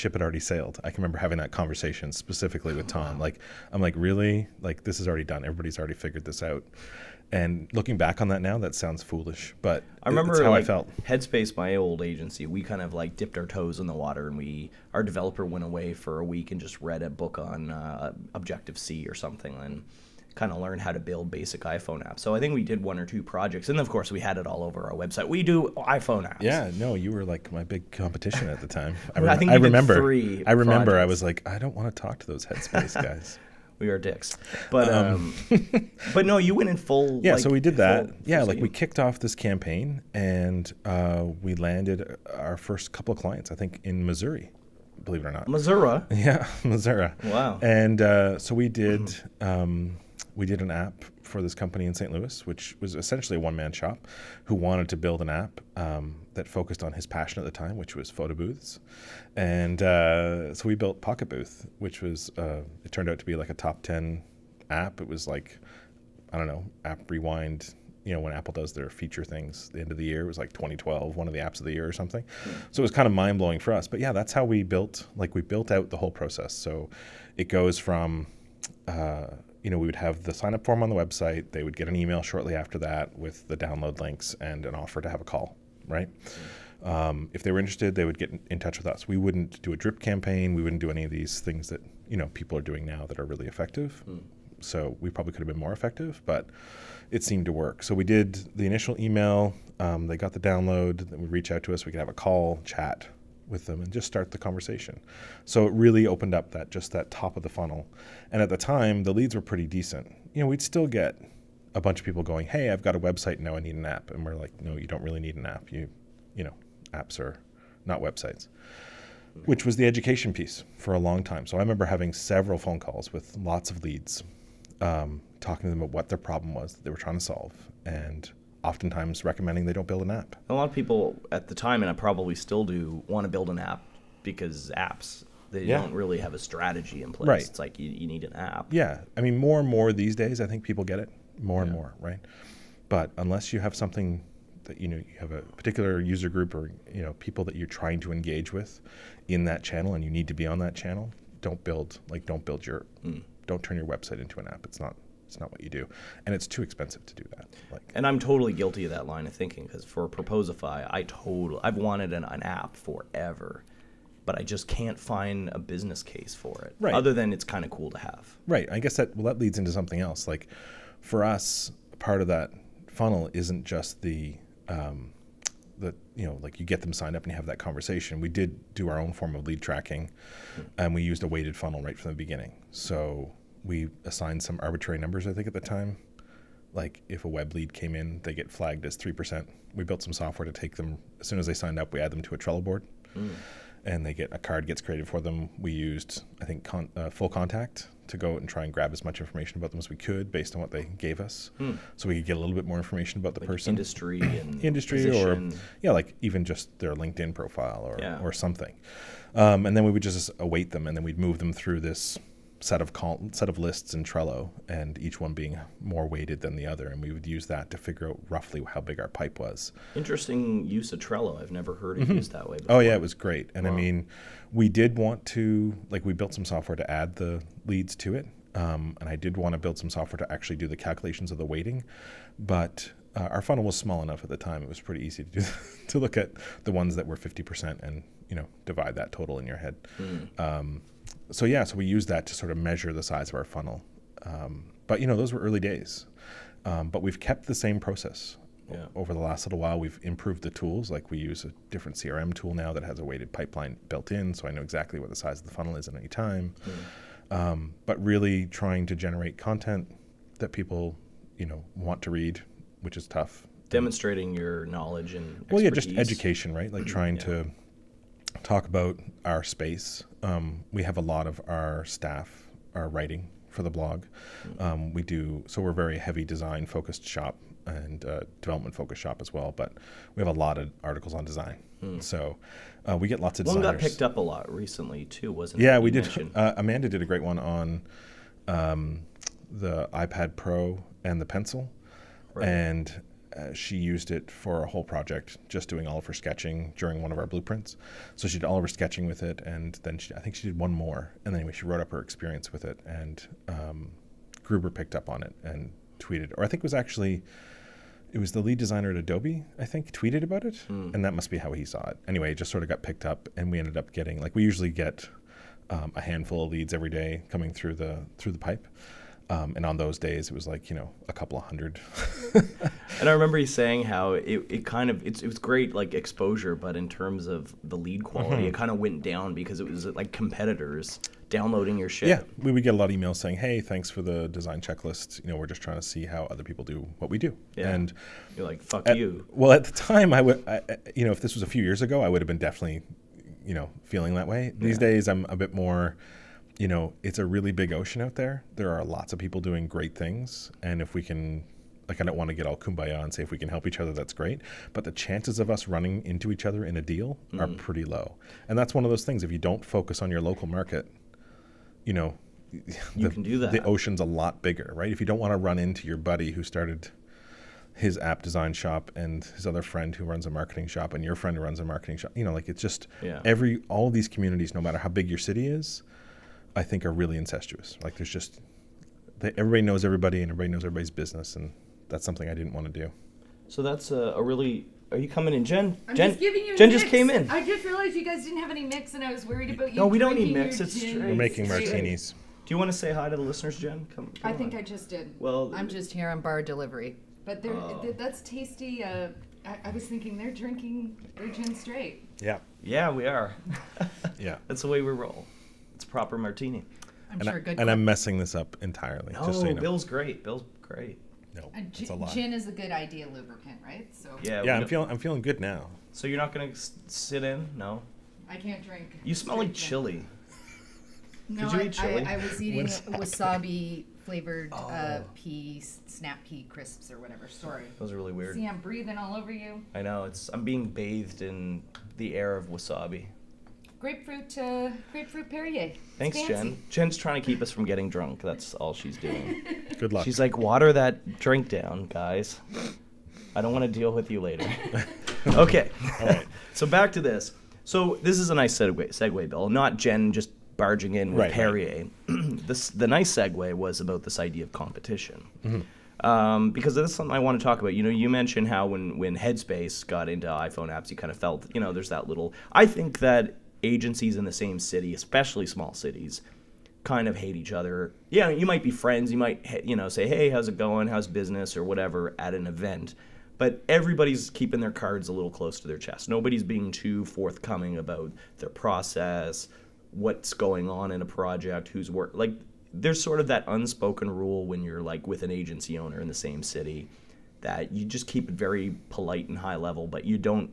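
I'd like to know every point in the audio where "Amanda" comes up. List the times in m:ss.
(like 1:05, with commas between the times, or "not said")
4:46.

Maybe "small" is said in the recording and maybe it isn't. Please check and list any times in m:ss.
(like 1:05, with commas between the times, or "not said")
3:53, 7:45.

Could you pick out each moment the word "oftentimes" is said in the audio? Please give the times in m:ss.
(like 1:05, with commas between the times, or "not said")
2:08.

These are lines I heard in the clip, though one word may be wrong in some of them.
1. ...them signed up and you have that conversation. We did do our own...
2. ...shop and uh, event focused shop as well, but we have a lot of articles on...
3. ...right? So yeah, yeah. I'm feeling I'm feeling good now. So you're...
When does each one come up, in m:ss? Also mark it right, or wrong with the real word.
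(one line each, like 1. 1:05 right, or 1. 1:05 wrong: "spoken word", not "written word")
1. 2:56 right
2. 4:37 wrong: "development", not "event"
3. 6:53 right.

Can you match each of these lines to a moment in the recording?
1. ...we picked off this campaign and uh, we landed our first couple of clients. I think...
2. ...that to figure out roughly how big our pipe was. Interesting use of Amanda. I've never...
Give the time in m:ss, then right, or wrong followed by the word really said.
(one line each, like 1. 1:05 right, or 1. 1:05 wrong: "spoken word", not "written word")
1. 0:38 wrong: "kicked", not "picked"
2. 3:37 wrong: "Trello", not "Amanda".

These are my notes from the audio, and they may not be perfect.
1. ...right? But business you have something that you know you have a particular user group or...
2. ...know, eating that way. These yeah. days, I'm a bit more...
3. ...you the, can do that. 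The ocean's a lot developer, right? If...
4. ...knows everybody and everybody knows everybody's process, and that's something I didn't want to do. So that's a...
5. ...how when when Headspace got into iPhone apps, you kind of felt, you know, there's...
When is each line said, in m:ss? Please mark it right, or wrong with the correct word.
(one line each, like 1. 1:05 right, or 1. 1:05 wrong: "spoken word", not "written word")
1. 2:21 wrong: "unless", not "business"
2. 5:43 wrong: "feeling", not "eating"
3. 6:02 wrong: "bigger", not "developer"
4. 6:19 wrong: "business", not "process"
5. 7:38 right.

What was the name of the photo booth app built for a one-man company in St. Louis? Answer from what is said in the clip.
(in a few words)
Pocket Booth.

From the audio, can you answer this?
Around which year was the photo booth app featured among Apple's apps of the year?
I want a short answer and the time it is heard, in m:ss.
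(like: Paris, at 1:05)
2012, at 1:10.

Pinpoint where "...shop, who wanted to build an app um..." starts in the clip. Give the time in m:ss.
0:53.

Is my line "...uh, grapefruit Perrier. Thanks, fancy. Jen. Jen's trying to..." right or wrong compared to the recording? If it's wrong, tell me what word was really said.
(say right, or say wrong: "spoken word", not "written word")
right.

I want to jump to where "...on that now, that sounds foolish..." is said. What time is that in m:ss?
0:08.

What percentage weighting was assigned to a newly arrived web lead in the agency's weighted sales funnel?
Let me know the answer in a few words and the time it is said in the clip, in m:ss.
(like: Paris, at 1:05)
3%, at 3:08.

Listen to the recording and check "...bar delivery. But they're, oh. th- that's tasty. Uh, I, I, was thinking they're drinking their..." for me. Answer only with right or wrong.
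right.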